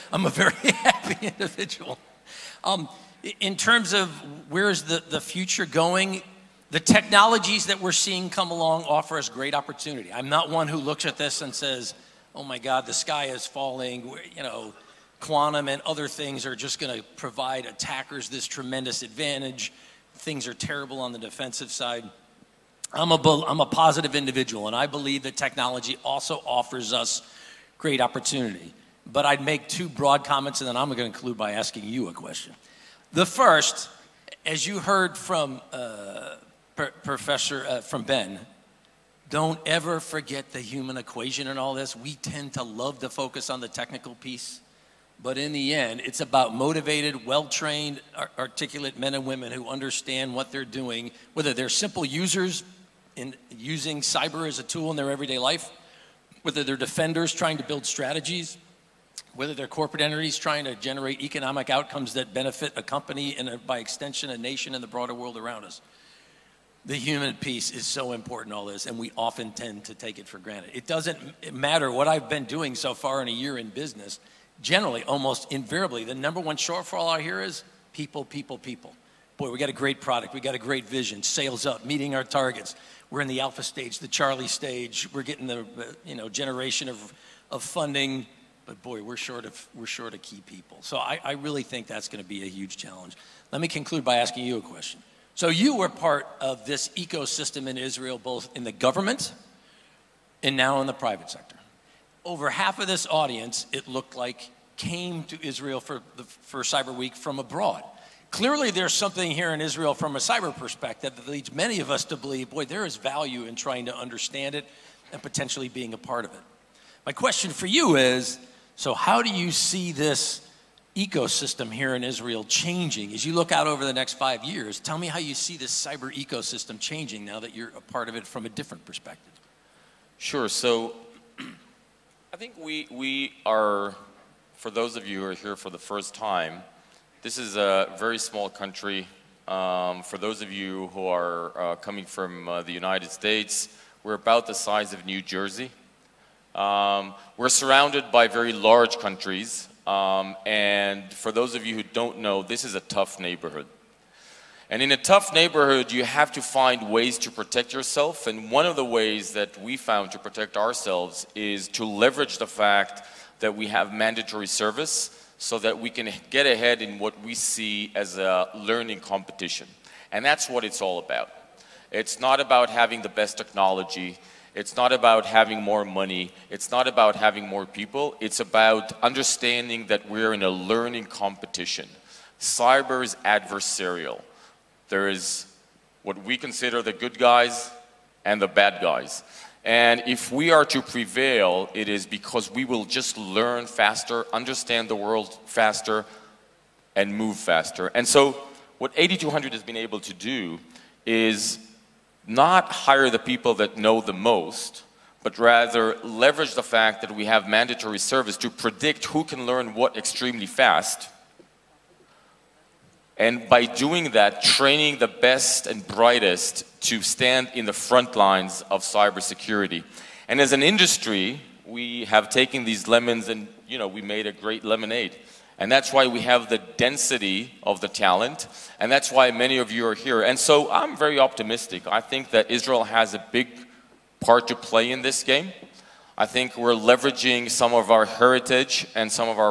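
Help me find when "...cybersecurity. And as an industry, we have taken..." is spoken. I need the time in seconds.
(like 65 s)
218 s.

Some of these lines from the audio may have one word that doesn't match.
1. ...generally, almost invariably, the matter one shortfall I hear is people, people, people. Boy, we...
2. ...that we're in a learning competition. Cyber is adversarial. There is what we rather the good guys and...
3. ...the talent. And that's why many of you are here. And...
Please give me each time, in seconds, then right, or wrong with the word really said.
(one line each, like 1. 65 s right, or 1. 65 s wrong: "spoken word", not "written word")
1. 74 s wrong: "number", not "matter"
2. 179 s wrong: "consider", not "rather"
3. 227 s right.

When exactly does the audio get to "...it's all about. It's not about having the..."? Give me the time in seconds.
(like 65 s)
170 s.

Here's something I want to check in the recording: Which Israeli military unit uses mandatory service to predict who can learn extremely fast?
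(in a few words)
8200.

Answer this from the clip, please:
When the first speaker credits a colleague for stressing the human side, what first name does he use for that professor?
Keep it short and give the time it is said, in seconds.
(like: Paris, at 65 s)
Ben, at 38 s.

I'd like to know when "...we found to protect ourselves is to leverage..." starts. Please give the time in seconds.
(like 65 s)
159 s.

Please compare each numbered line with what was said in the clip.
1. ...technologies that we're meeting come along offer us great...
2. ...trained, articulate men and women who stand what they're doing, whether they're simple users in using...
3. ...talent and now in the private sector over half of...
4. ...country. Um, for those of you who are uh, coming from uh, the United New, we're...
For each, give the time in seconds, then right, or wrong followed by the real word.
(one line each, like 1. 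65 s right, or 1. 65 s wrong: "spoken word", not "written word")
1. 6 s wrong: "seeing", not "meeting"
2. 47 s wrong: "understand", not "stand"
3. 98 s wrong: "government", not "talent"
4. 138 s wrong: "States", not "New".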